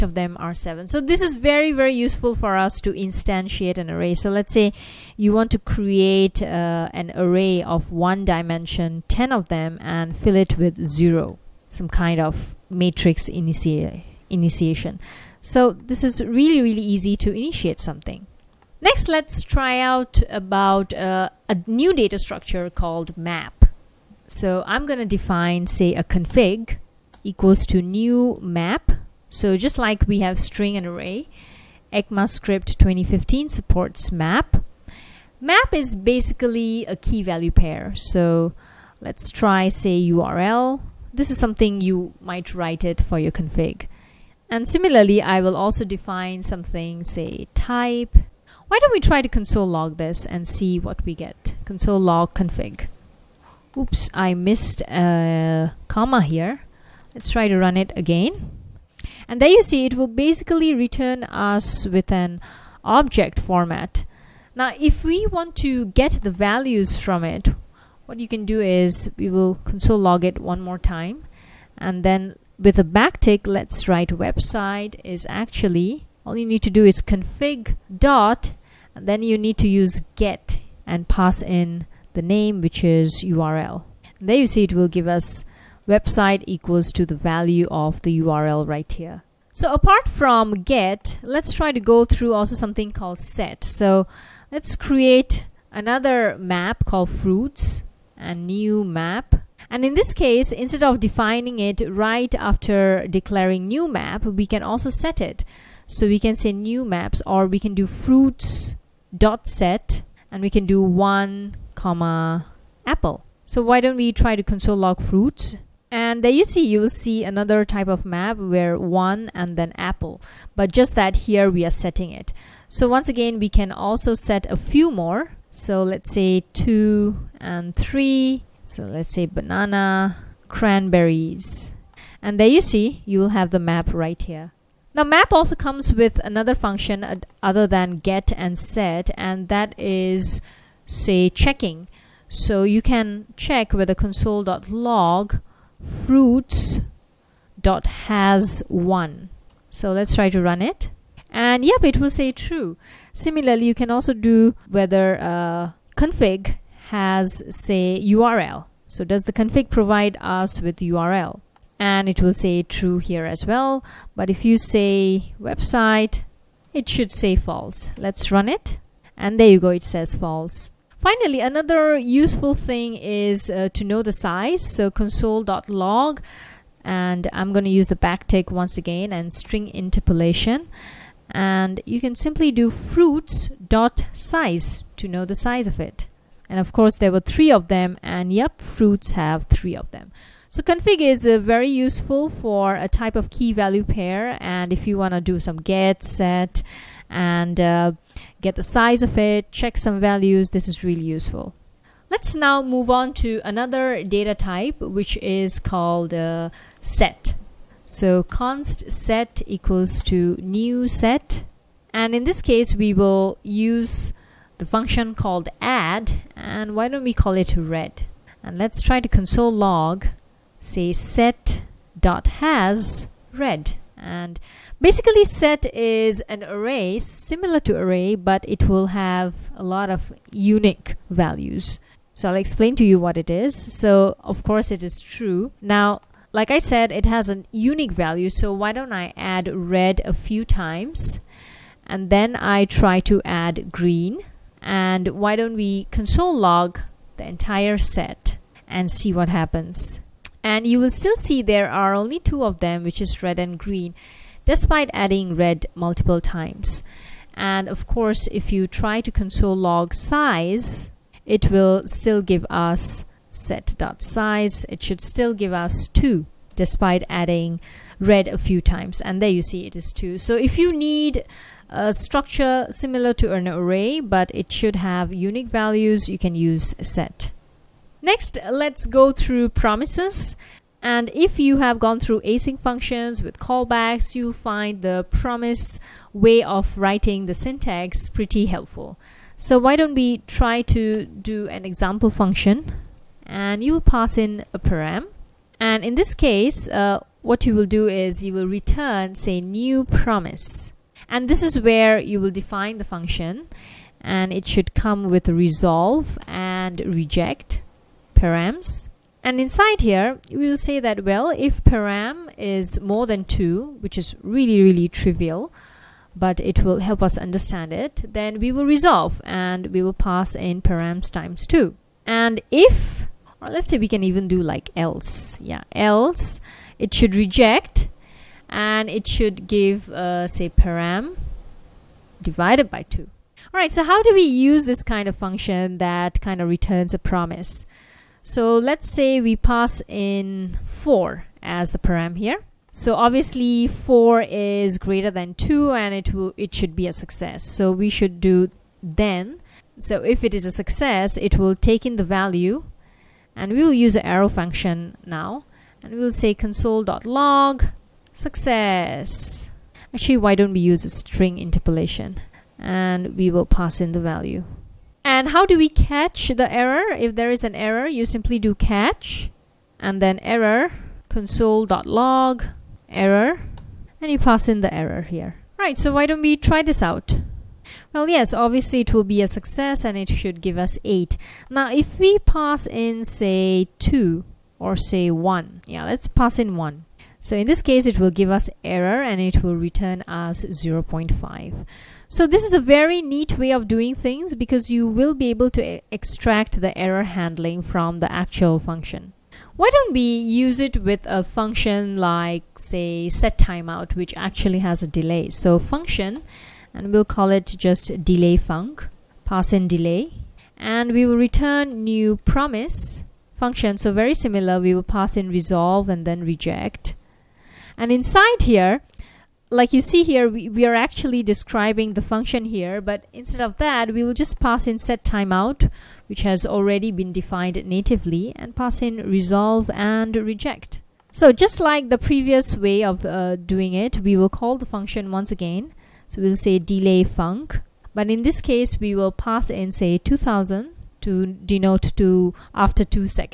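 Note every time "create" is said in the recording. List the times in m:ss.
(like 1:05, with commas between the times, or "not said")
0:05, 1:34.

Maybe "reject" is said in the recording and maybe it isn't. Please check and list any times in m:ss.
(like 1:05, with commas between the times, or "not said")
5:06, 5:27, 6:56, 7:10.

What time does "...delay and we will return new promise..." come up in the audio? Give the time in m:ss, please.
6:49.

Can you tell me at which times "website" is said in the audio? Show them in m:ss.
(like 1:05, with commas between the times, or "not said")
1:14, 1:25, 2:45.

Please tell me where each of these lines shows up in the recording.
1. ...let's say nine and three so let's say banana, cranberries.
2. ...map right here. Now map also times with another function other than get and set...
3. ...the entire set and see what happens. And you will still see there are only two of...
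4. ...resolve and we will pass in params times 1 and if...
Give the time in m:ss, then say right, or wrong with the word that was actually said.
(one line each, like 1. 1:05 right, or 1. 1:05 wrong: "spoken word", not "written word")
1. 2:05 wrong: "two", not "nine"
2. 2:13 wrong: "comes", not "times"
3. 4:07 right
4. 5:18 wrong: "2", not "1".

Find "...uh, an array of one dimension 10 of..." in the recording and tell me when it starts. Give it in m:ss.
0:06.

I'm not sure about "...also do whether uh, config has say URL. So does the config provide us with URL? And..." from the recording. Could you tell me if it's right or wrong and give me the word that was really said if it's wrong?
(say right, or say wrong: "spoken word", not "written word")
right.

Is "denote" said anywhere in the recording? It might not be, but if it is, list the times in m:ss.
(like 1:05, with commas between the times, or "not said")
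7:21.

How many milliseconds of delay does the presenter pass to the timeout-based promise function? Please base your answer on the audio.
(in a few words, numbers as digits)
2000.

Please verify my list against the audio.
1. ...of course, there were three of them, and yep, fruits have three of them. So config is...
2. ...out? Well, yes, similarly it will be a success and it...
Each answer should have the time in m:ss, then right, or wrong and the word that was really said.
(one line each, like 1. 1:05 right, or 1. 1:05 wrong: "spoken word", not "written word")
1. 3:06 right
2. 6:16 wrong: "obviously", not "similarly".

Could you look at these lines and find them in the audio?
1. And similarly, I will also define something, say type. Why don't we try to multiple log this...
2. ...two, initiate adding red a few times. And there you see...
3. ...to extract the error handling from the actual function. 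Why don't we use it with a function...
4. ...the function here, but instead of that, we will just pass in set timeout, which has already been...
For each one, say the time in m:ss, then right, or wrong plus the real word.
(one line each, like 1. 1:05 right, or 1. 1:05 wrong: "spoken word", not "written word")
1. 0:44 wrong: "console", not "multiple"
2. 4:25 wrong: "despite", not "initiate"
3. 6:35 right
4. 7:01 right.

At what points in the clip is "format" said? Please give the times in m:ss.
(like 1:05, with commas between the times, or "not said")
1:03.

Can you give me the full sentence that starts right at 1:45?
So we can say new maps or we can do fruits dot set and we can do one comma apple.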